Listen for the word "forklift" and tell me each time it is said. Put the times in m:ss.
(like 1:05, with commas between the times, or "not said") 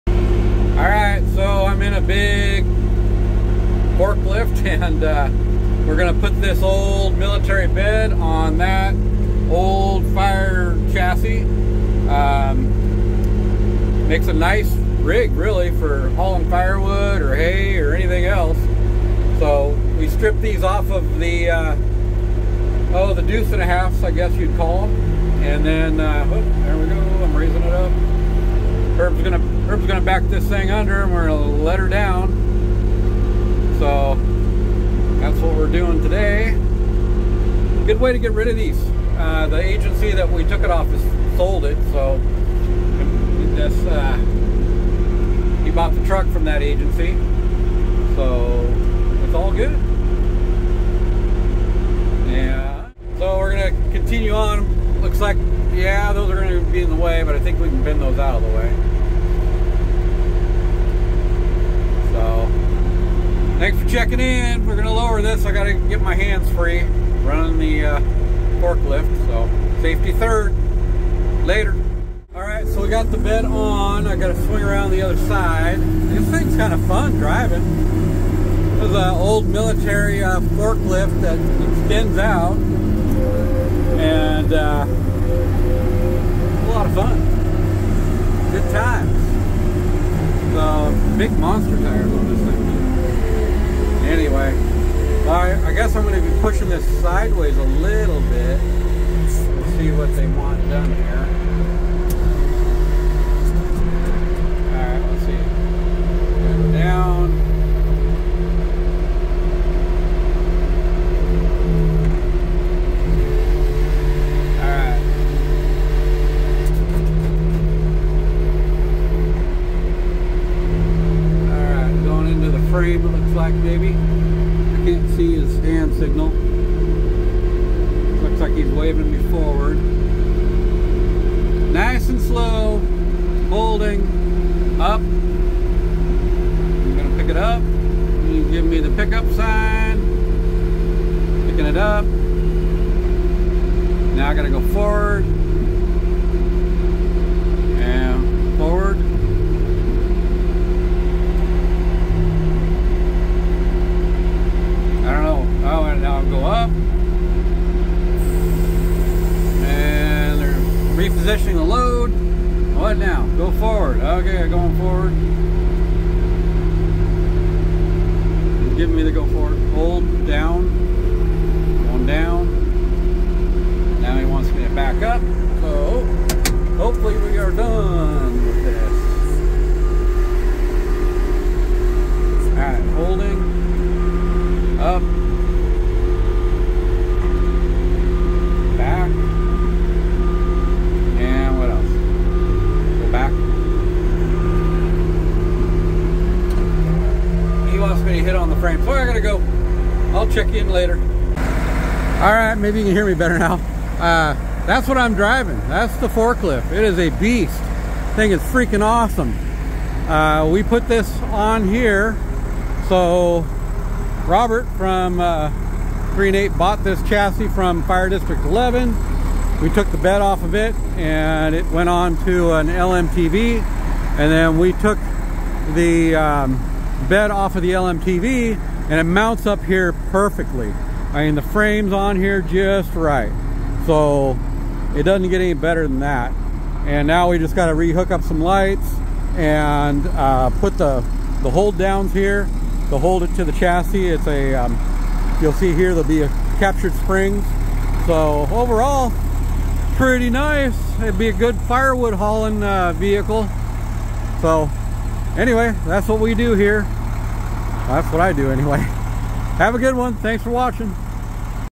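0:03, 1:08, 1:20, 3:26.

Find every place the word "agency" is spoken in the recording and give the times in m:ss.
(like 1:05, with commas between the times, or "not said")
0:39, 0:46.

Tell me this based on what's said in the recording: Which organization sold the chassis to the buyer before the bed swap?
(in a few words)
Fire District 11.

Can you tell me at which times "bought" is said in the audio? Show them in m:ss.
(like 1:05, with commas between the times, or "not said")
0:45, 3:36.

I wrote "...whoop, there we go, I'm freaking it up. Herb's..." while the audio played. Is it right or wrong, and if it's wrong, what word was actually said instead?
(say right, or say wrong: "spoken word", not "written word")
wrong: "raising", not "freaking".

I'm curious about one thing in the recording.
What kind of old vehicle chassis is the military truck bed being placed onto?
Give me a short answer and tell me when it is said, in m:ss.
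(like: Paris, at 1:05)
Fire chassis, at 0:10.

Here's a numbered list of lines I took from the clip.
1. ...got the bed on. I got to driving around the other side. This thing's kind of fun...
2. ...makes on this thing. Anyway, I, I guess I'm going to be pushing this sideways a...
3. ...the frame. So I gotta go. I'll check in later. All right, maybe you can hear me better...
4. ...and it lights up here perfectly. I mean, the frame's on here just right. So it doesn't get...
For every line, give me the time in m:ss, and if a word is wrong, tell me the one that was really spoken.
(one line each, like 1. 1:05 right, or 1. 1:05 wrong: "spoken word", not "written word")
1. 1:12 wrong: "swing", not "driving"
2. 1:31 wrong: "tires", not "makes"
3. 3:18 right
4. 3:48 wrong: "mounts", not "lights".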